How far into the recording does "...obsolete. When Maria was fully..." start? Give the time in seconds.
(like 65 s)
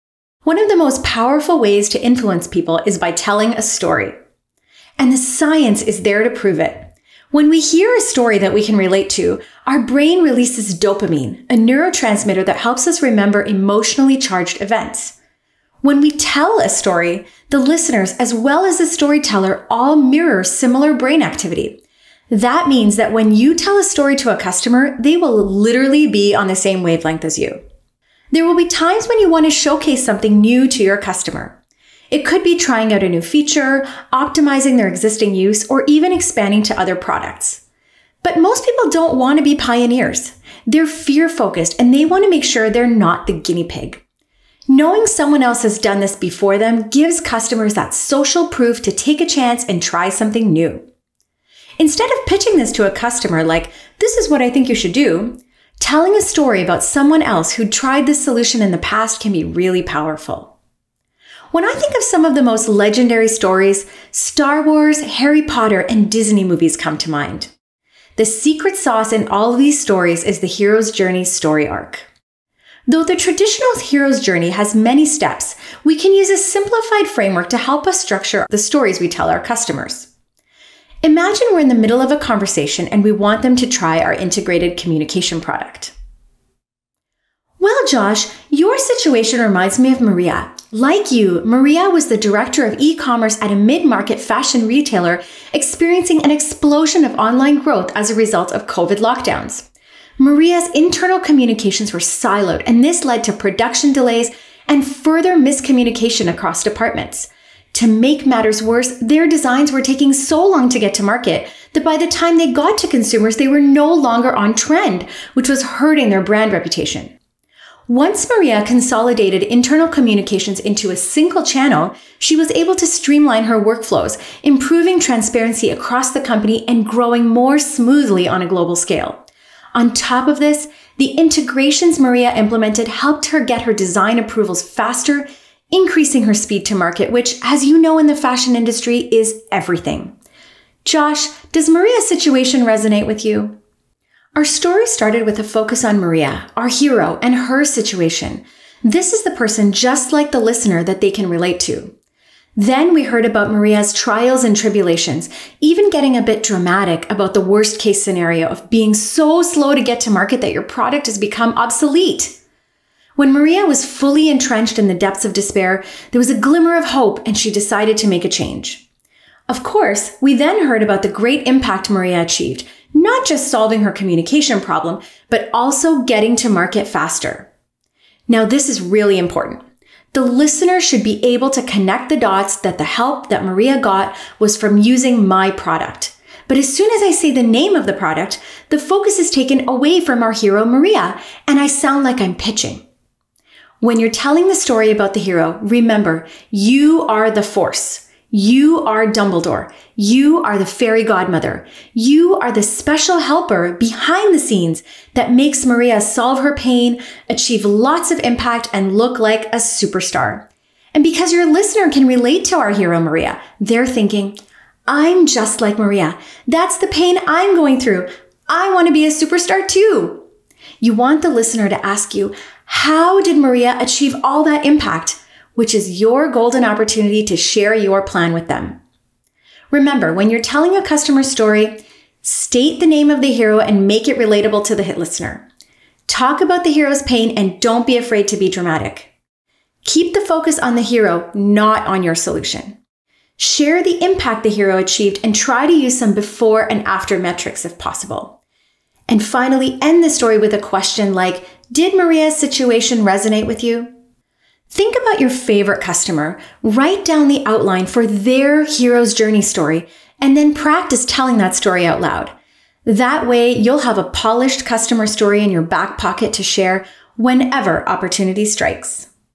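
161 s.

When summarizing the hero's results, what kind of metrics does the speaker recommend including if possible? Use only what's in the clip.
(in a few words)
before and after metrics.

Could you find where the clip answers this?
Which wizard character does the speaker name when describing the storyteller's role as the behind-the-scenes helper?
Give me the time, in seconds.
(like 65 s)
199 s.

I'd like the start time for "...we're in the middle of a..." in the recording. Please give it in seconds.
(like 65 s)
81 s.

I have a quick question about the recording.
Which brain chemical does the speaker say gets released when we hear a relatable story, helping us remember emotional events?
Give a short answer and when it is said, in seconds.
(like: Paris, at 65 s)
dopamine, at 10 s.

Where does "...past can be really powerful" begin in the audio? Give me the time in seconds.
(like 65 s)
58 s.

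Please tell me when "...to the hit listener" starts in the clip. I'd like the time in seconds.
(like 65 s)
234 s.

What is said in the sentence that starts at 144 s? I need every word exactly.
Our story started with a focus on Maria, our hero, and her situation.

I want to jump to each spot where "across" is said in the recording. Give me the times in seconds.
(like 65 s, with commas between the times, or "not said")
106 s, 125 s.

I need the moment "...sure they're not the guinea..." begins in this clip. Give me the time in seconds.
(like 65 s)
42 s.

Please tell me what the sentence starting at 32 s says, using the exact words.
It could be trying out a new feature, optimizing their existing use, or even expanding to other products.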